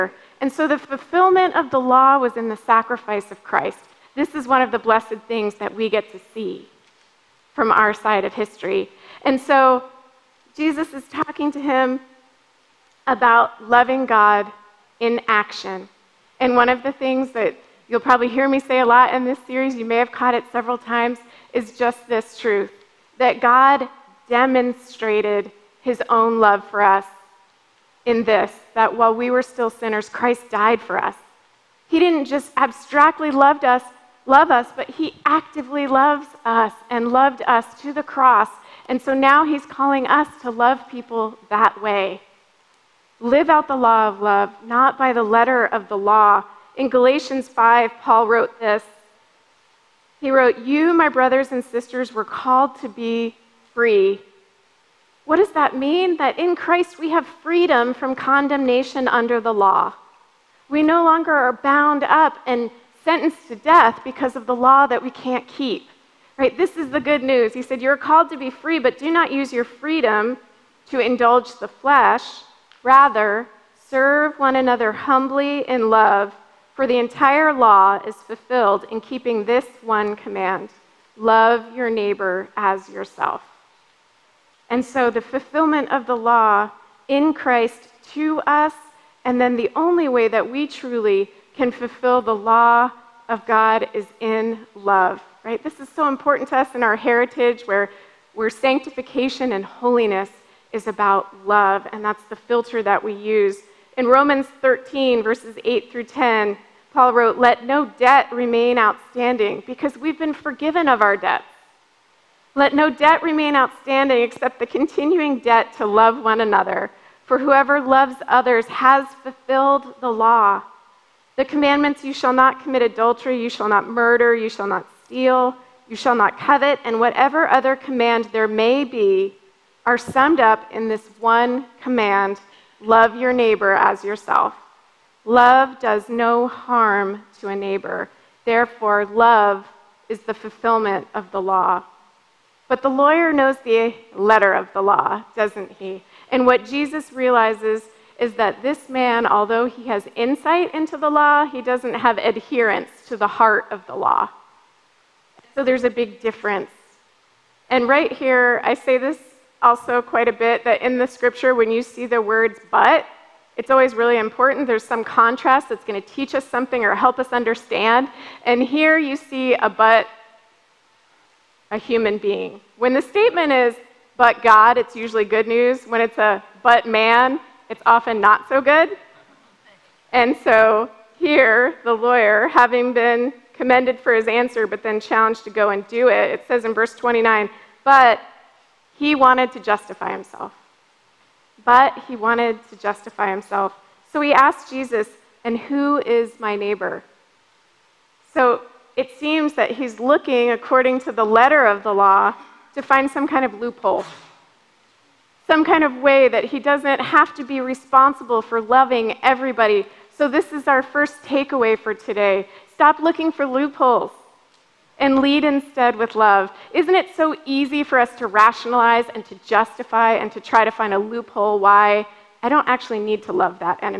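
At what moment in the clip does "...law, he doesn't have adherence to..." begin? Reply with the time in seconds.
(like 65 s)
151 s.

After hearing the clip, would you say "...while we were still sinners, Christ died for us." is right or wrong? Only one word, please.
right.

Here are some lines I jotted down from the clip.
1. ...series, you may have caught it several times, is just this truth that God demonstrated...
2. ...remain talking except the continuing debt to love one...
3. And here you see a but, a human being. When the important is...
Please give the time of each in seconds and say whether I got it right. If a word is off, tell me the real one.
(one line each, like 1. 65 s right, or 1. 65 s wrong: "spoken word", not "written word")
1. 19 s right
2. 113 s wrong: "outstanding", not "talking"
3. 168 s wrong: "statement", not "important".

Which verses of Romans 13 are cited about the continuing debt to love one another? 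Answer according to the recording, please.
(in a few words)
8 through 10.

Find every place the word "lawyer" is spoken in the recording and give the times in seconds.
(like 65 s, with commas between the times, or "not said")
142 s, 181 s.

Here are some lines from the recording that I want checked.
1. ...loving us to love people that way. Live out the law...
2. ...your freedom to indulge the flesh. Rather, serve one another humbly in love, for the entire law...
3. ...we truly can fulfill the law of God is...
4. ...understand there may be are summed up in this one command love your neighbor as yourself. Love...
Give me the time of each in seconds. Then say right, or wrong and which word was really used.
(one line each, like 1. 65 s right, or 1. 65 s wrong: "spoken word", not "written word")
1. 39 s wrong: "calling", not "loving"
2. 69 s right
3. 90 s right
4. 127 s wrong: "command", not "understand".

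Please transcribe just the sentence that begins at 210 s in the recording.
So, this is our first takeaway for today.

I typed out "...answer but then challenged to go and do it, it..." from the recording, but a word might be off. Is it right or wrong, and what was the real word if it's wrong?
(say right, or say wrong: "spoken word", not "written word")
right.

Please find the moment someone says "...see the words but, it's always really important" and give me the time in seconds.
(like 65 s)
161 s.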